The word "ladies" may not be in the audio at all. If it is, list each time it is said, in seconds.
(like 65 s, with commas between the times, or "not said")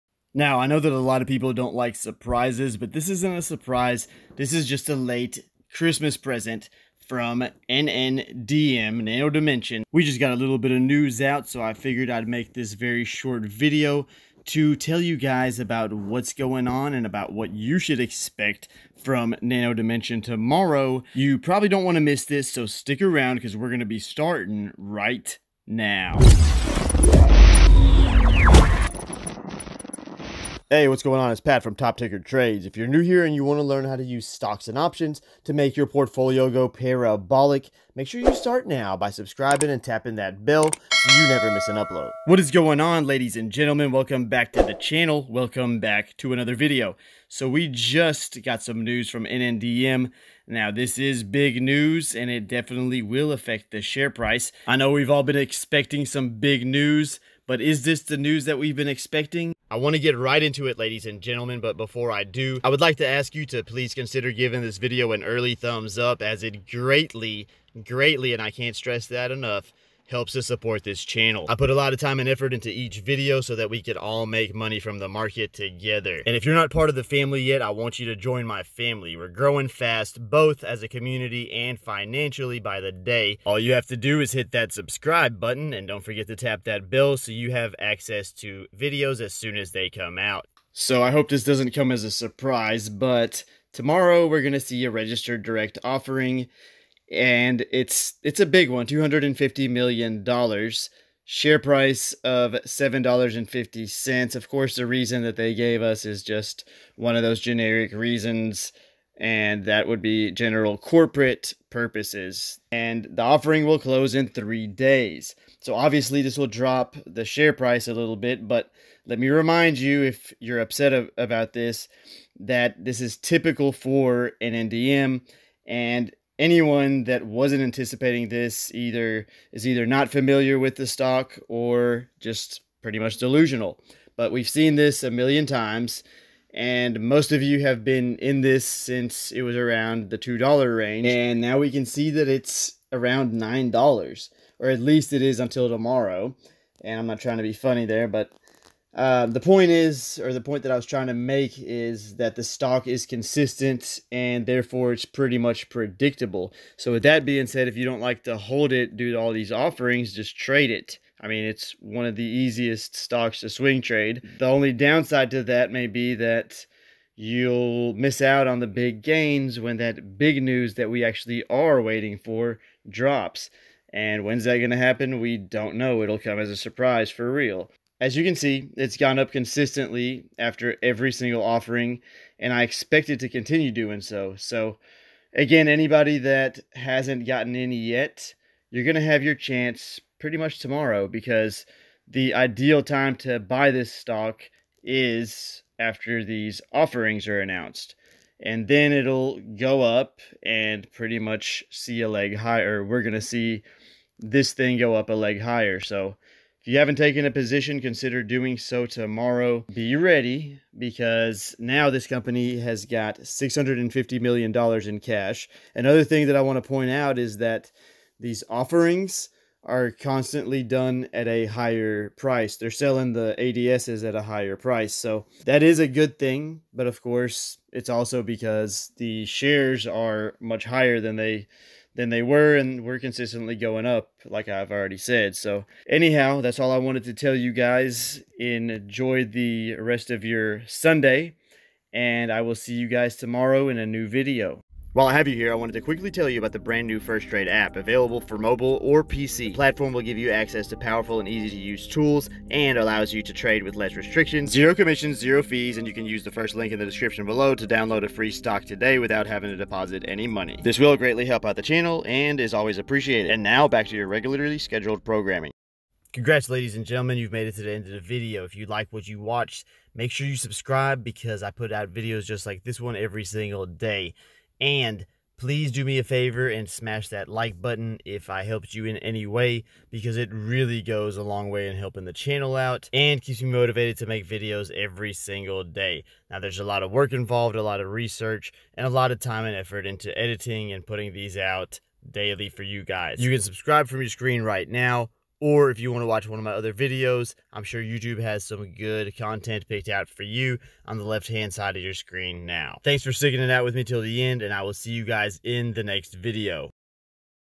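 43 s, 60 s, 266 s.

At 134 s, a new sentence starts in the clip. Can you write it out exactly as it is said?
But we've seen this a million times, and most of you have been in this since it was around the $2 range.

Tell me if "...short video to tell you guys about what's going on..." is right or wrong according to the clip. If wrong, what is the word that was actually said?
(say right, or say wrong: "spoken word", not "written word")
right.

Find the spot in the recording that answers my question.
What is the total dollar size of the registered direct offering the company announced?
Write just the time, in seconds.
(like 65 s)
98 s.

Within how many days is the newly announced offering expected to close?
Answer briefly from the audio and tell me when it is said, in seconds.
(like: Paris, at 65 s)
3 days, at 114 s.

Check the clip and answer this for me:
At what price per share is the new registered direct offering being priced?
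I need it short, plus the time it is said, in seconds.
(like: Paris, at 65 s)
$7.50, at 102 s.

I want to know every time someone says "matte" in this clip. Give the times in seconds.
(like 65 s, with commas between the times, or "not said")
not said.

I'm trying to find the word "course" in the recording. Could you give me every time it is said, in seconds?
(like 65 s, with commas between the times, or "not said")
104 s, 227 s.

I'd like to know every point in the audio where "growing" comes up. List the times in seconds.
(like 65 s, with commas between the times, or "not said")
79 s.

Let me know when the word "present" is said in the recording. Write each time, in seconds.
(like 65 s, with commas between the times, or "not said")
6 s.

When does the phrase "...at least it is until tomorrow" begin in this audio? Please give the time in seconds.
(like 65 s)
144 s.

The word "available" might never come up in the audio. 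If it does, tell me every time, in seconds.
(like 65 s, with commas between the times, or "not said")
247 s.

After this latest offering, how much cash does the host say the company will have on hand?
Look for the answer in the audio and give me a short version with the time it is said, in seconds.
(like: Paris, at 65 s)
$650 million, at 213 s.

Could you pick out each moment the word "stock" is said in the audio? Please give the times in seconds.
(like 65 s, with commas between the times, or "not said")
34 s, 130 s, 152 s, 162 s, 193 s, 258 s.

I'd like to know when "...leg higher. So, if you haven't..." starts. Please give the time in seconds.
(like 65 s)
205 s.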